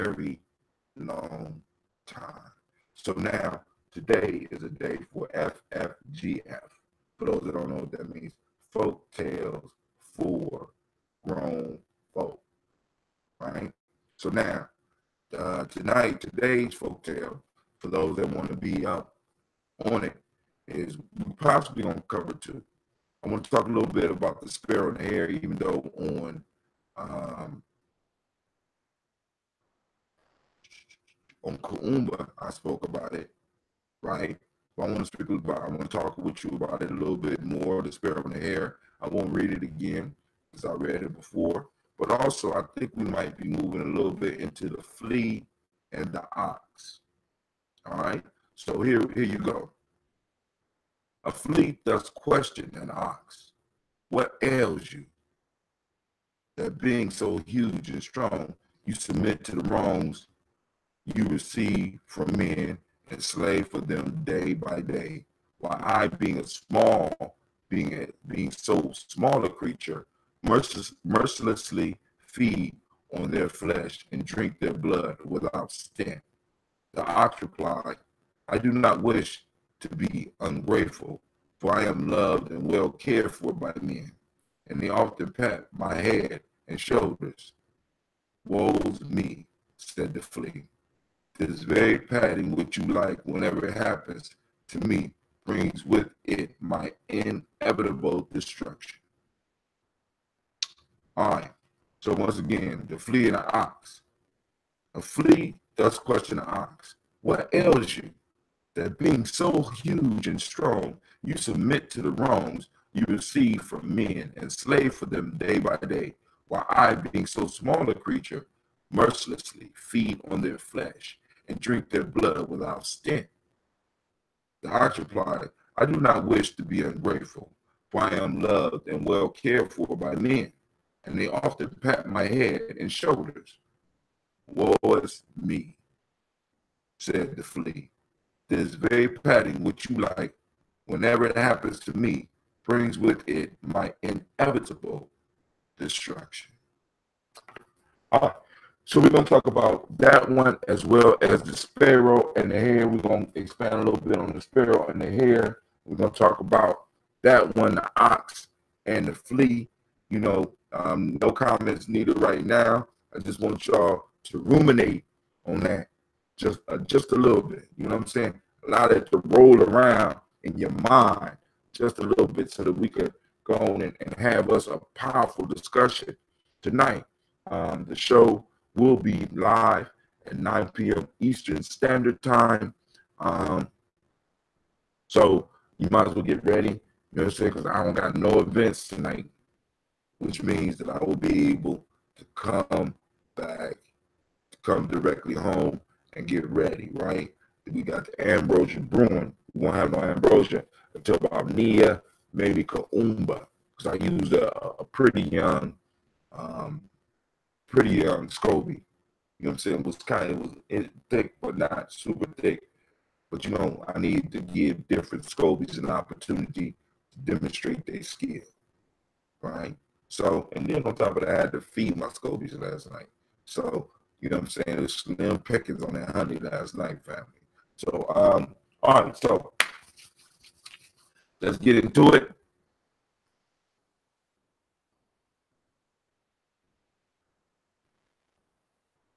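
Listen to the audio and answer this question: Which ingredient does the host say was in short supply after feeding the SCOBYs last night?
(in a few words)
Honey.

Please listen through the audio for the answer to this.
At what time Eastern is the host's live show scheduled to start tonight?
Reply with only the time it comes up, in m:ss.
3:00.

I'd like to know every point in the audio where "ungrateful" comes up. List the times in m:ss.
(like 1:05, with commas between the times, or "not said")
1:20, 2:06.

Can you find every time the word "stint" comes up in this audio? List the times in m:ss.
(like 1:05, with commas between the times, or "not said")
1:15, 2:02.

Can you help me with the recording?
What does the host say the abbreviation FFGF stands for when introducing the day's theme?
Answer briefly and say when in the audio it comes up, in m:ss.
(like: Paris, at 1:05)
Folk tales for grown folk, at 0:08.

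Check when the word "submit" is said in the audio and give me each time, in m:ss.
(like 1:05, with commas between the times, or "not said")
0:58, 1:51.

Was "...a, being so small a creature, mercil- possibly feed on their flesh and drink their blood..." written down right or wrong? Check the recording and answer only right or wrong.
wrong.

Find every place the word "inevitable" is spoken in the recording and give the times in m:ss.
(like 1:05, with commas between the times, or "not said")
1:37, 2:24.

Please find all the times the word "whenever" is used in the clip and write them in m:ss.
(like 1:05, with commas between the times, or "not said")
1:33, 2:20.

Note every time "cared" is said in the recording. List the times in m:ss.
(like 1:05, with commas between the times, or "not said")
1:22, 2:09.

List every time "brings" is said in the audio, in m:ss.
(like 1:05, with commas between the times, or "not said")
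1:35, 2:22.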